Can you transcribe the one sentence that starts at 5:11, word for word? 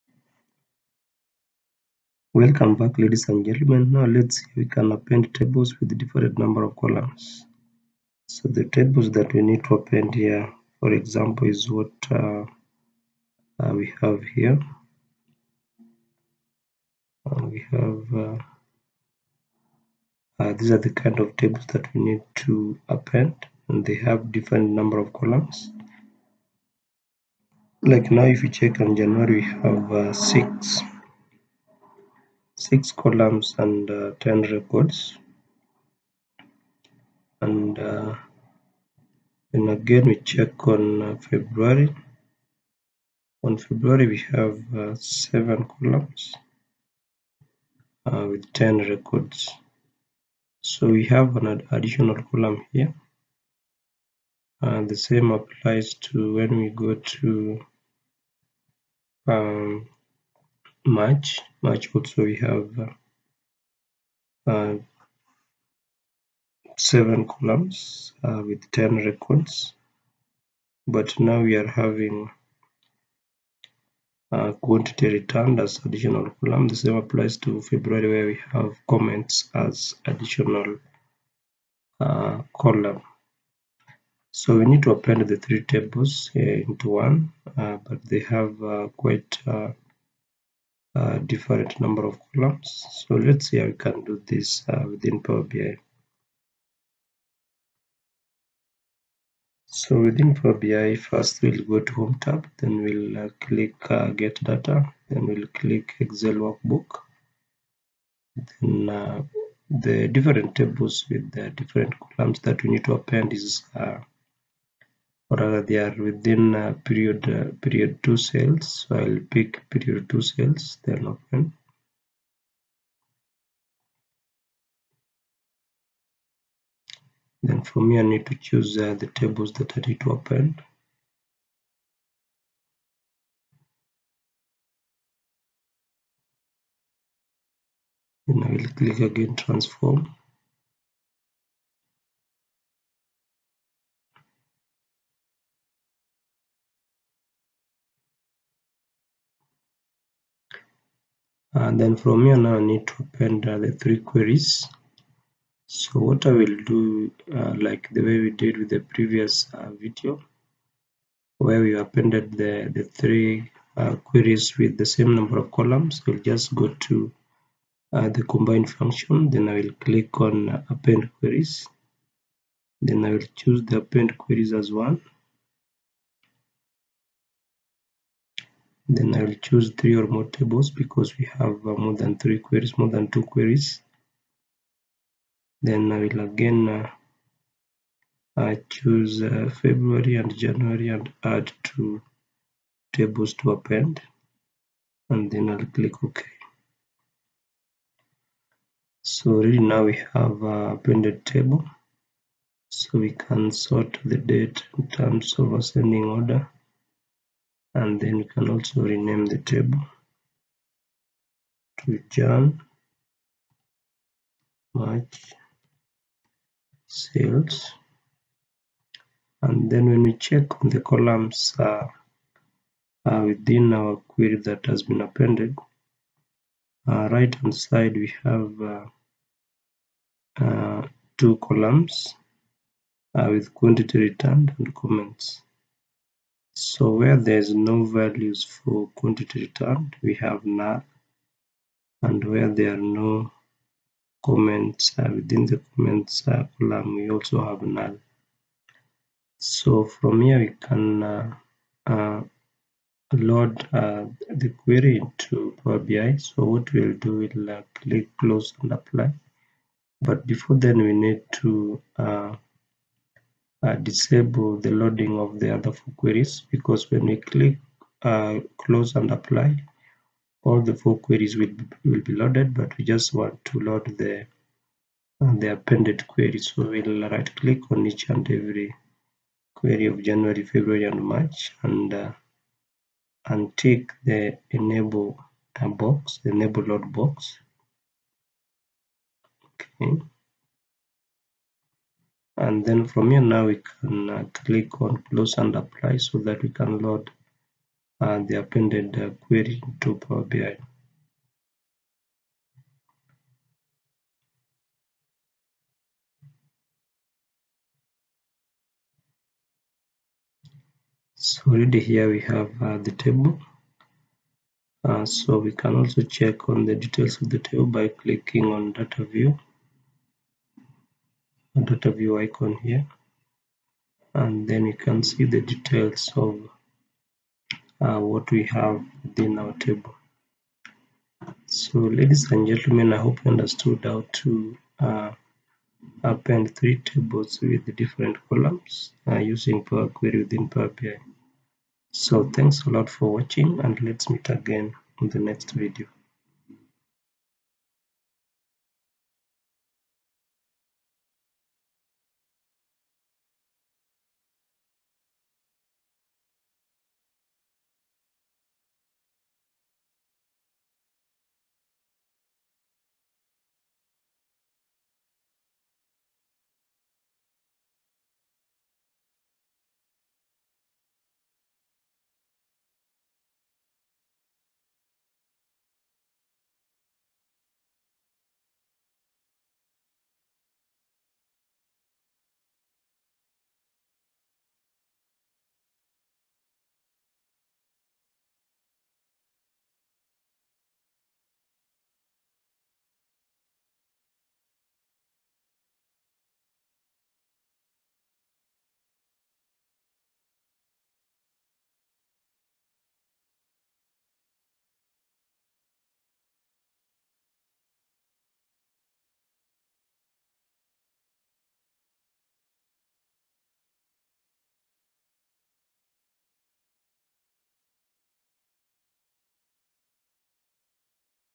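So already here we have uh, the table.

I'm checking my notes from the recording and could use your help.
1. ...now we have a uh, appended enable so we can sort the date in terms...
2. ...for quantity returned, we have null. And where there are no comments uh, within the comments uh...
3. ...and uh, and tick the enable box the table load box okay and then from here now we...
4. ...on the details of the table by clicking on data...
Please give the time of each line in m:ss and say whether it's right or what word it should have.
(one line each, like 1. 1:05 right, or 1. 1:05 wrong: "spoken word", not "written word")
1. 3:19 wrong: "table", not "enable"
2. 3:58 right
3. 4:41 wrong: "enable", not "table"
4. 5:16 right.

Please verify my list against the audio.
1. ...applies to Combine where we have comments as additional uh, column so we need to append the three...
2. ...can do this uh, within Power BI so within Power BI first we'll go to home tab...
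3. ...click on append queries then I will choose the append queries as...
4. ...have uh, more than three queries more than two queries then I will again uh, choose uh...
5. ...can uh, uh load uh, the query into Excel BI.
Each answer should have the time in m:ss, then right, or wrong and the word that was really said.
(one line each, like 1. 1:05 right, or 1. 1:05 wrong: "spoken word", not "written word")
1. 1:16 wrong: "February", not "Combine"
2. 1:33 right
3. 2:49 right
4. 3:01 right
5. 4:10 wrong: "Power", not "Excel".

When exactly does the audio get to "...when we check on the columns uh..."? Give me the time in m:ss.
3:39.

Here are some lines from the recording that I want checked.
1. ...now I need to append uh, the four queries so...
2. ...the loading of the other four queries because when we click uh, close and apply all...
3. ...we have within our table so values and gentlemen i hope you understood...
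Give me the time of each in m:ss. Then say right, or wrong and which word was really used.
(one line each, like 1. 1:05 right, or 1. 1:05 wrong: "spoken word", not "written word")
1. 2:32 wrong: "three", not "four"
2. 4:24 right
3. 5:28 wrong: "ladies", not "values".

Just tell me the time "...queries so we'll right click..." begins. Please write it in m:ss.
4:36.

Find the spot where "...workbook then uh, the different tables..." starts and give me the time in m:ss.
1:46.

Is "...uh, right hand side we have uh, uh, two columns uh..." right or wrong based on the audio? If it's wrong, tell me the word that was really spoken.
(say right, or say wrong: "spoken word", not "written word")
right.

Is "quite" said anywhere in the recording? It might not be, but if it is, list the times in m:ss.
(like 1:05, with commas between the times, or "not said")
1:28.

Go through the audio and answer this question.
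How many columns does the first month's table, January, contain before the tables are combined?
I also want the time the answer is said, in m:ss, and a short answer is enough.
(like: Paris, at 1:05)
6, at 0:32.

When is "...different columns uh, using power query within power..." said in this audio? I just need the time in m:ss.
5:37.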